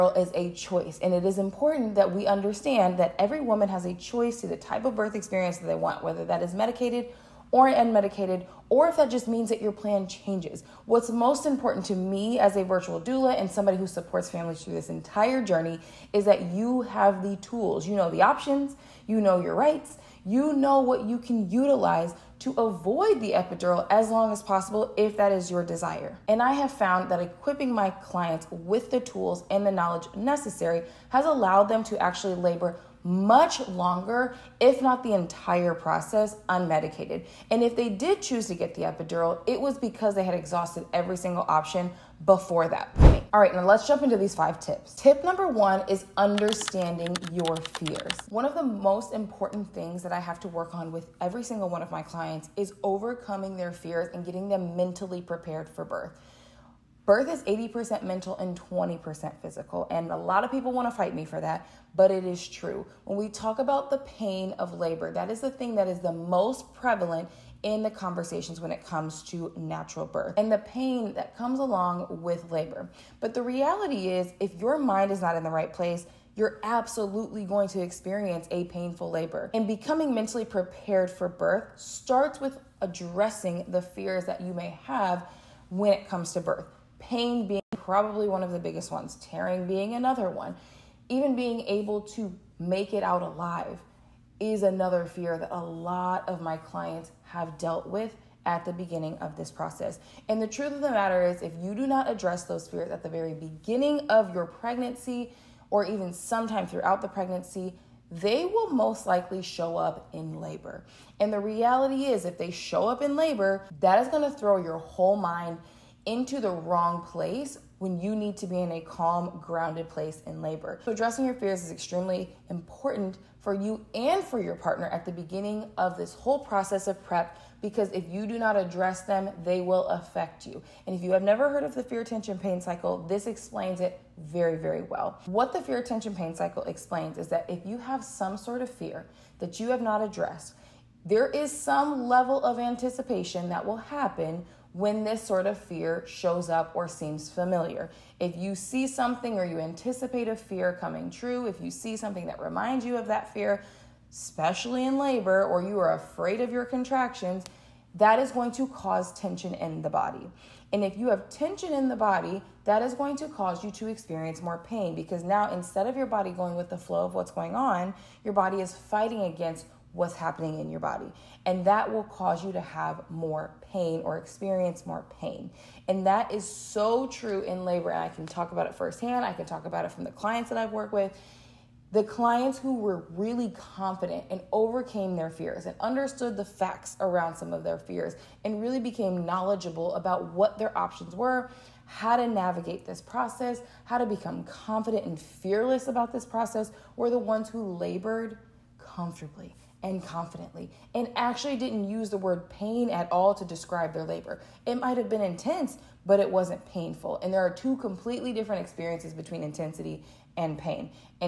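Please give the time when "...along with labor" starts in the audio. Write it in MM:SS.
01:11.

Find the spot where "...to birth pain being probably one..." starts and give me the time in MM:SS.
01:26.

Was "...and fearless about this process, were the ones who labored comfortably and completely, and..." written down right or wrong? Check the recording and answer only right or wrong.
wrong.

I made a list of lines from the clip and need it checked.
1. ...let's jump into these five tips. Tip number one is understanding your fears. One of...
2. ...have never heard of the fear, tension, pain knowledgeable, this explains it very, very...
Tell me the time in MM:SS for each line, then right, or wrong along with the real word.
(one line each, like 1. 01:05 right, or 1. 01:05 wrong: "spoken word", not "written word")
1. 00:43 right
2. 02:11 wrong: "cycle", not "knowledgeable".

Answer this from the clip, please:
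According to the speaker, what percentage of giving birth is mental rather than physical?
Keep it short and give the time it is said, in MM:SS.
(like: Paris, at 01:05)
80%, at 00:57.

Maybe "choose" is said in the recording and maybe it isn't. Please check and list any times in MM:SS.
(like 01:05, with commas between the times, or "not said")
00:38.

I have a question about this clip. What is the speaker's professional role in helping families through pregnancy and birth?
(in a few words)
Virtual doula.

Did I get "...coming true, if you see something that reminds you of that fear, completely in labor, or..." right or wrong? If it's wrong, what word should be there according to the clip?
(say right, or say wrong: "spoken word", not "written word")
wrong: "especially", not "completely".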